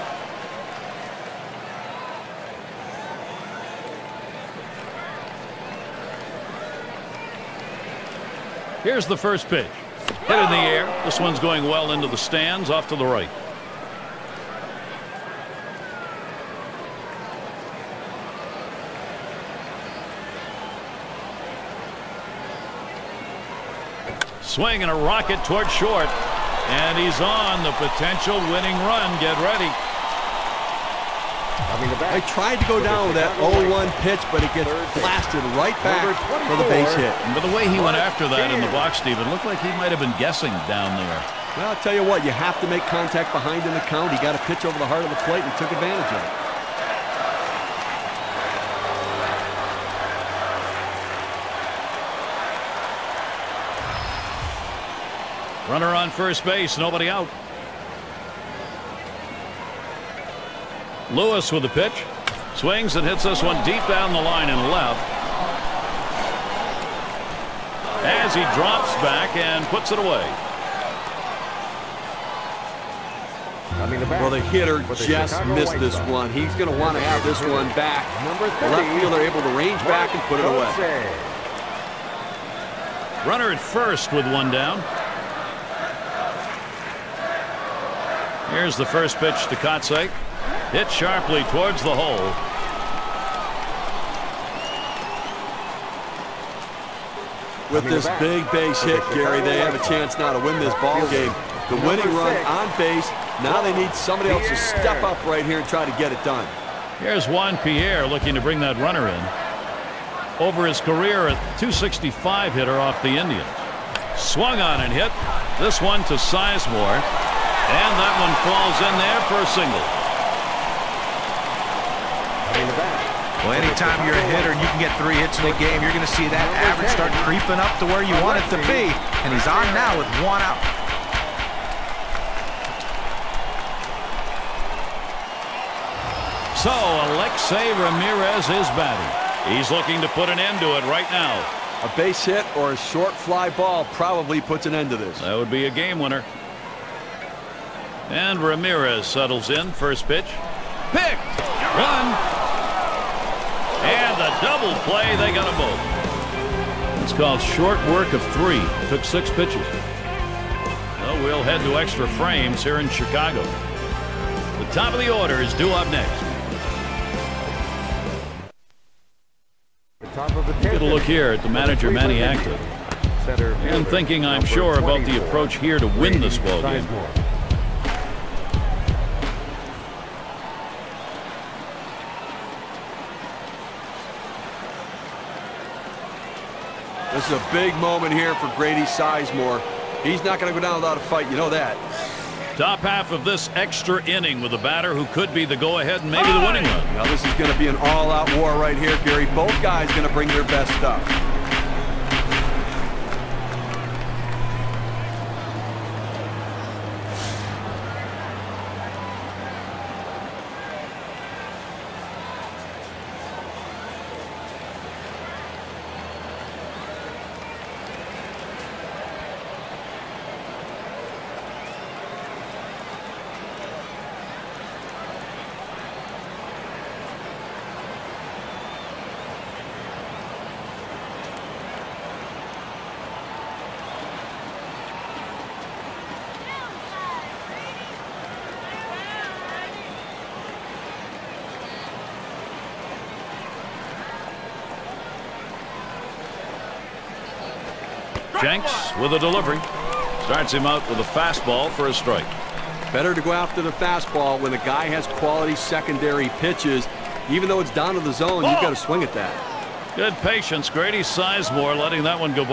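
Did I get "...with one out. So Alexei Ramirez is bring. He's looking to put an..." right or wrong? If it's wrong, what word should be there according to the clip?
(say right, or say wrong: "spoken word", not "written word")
wrong: "batting", not "bring".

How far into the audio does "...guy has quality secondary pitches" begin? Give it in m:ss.
4:14.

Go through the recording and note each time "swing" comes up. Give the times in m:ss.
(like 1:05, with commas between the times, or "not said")
0:24, 1:02, 4:18.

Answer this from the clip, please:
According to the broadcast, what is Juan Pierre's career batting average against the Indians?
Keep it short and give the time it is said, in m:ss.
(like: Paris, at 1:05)
.265, at 1:51.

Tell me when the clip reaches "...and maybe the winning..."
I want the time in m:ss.
3:16.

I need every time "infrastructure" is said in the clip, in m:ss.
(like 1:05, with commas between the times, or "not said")
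not said.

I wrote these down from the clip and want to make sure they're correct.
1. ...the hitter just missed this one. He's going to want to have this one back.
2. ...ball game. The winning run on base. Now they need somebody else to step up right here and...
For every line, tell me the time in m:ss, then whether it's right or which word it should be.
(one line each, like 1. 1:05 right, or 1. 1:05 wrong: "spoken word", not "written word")
1. 1:14 right
2. 1:40 right.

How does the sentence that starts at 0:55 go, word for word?
Runner on first base, nobody out.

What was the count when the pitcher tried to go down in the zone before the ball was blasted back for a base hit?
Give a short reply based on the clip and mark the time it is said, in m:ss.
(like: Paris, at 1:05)
0-1, at 0:33.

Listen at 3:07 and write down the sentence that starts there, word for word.
This is a big moment here for Grady Sizemore.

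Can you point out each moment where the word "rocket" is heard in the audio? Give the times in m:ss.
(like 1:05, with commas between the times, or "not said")
0:24.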